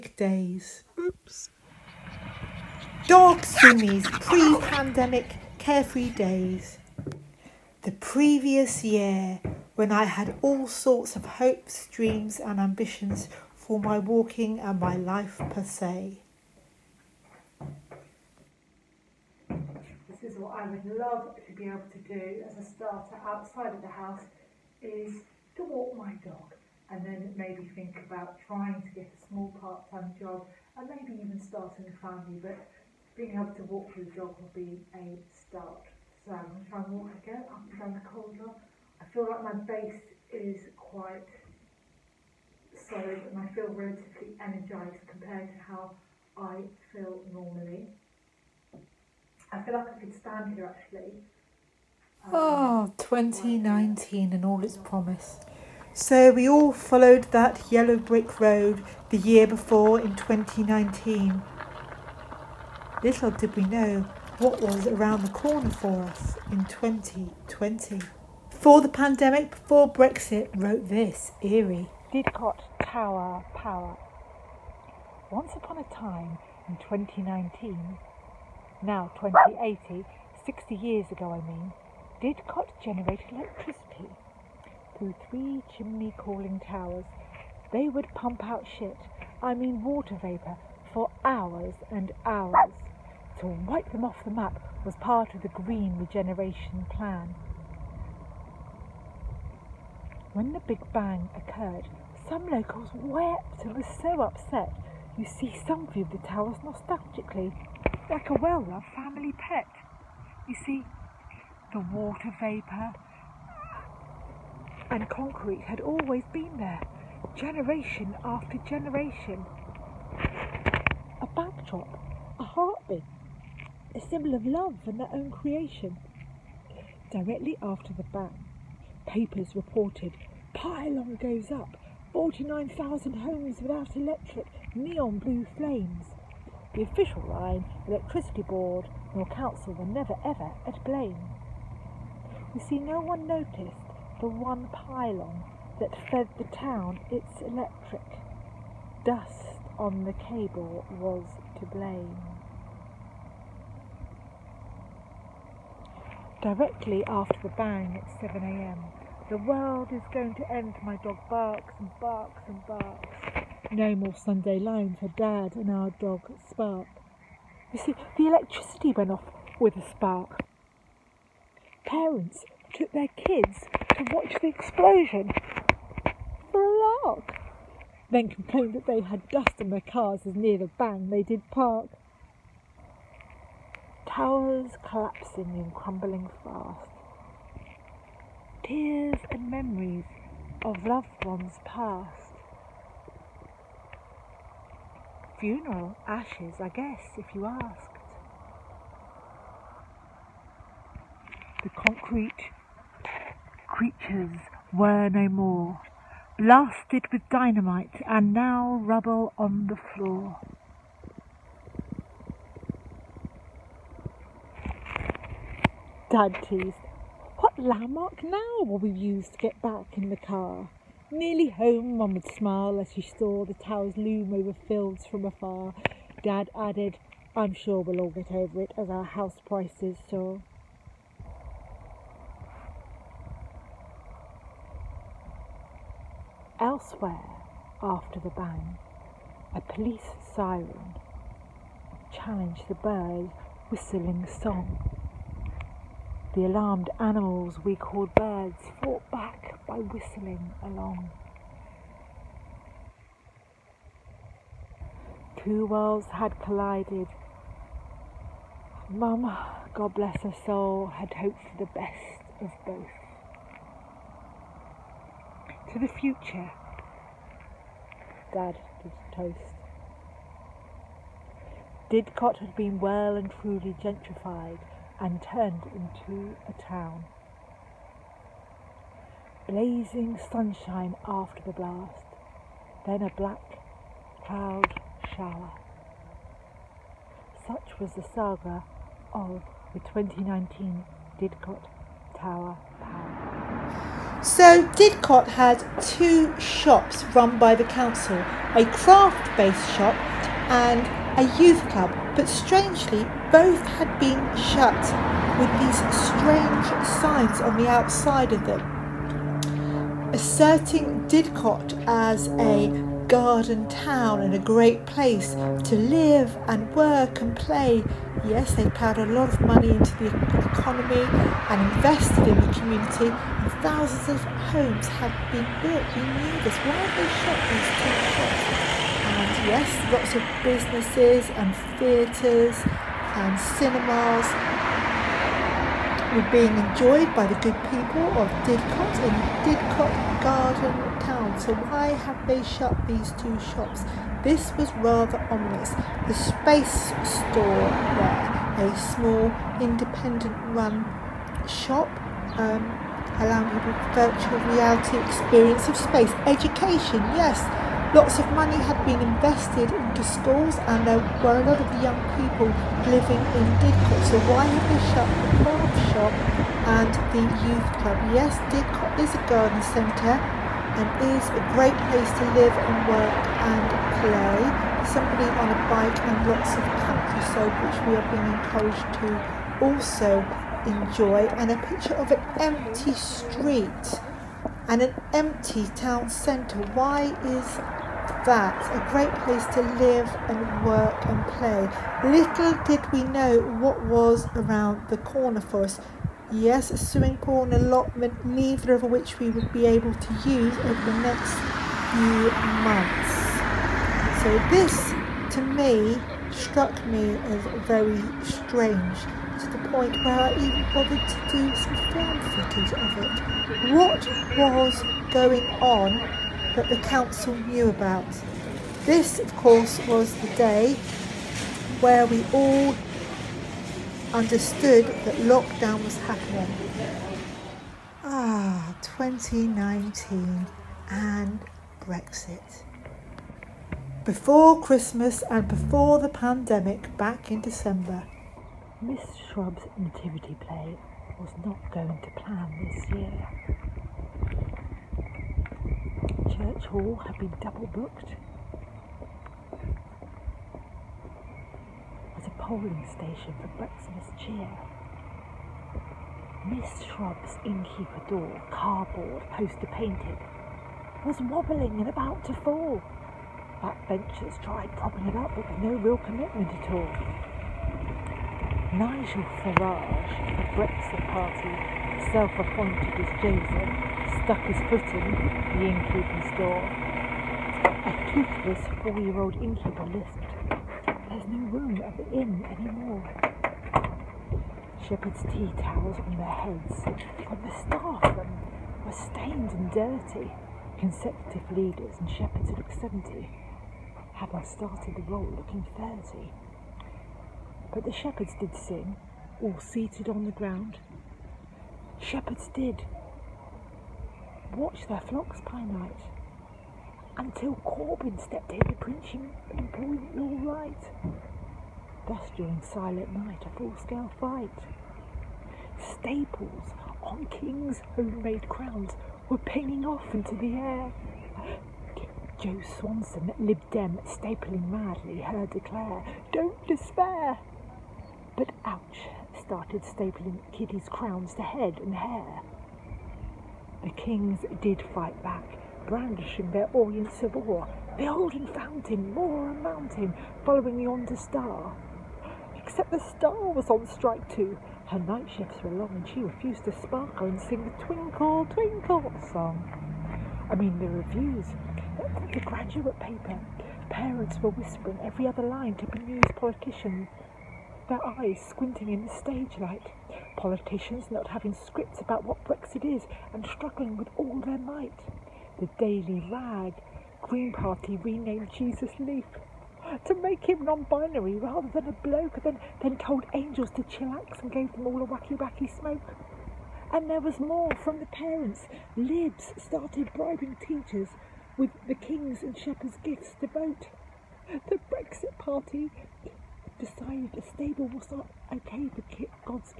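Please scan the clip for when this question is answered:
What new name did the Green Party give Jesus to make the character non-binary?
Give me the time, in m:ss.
9:28.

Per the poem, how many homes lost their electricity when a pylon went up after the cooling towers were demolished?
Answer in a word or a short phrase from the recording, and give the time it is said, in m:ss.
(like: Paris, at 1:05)
49,000, at 2:12.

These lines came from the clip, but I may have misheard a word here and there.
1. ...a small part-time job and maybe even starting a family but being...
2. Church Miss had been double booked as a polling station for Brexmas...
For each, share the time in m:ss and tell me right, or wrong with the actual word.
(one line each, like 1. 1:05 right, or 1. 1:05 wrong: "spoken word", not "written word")
1. 0:29 right
2. 7:26 wrong: "Hall", not "Miss".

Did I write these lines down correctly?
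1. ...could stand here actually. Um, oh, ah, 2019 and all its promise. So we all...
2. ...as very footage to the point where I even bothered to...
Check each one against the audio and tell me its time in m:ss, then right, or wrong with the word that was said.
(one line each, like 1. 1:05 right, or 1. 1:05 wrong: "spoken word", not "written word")
1. 0:49 right
2. 6:47 wrong: "strange", not "footage".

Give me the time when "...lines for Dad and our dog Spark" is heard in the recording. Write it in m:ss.
2:44.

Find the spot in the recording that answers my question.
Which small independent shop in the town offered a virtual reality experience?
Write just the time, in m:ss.
5:46.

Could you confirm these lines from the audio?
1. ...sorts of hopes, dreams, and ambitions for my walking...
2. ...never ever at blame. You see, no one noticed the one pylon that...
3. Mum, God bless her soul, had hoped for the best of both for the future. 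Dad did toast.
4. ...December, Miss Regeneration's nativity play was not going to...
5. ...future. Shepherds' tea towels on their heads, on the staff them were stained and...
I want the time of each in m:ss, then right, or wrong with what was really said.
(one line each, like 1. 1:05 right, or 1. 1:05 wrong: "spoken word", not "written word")
1. 0:10 right
2. 2:19 right
3. 4:18 right
4. 7:17 wrong: "Shrub", not "Regeneration"
5. 8:02 wrong: "anymore", not "future".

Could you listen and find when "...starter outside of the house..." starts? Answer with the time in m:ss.
0:22.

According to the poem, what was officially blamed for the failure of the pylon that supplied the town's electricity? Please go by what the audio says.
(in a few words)
Dust on the cable.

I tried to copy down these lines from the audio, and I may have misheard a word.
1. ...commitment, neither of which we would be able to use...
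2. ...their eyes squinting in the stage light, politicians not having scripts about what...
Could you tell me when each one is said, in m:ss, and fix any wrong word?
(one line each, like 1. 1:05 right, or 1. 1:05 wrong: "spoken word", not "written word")
1. 6:37 wrong: "allotment", not "commitment"
2. 9:17 right.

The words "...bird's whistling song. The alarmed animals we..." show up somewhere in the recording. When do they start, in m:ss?
4:02.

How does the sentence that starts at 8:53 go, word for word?
The kings did fight back, brandishing their orient sabre.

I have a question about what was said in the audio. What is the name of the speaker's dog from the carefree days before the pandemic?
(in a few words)
Sumi.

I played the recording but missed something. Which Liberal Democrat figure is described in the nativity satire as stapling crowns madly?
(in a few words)
Jo Swinson.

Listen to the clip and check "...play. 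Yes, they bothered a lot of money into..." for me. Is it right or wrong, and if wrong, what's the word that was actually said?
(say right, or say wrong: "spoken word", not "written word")
wrong: "poured", not "bothered".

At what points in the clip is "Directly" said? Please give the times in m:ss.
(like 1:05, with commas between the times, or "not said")
2:07, 2:36.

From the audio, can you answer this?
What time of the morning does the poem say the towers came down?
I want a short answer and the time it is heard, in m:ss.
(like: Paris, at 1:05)
7am, at 2:38.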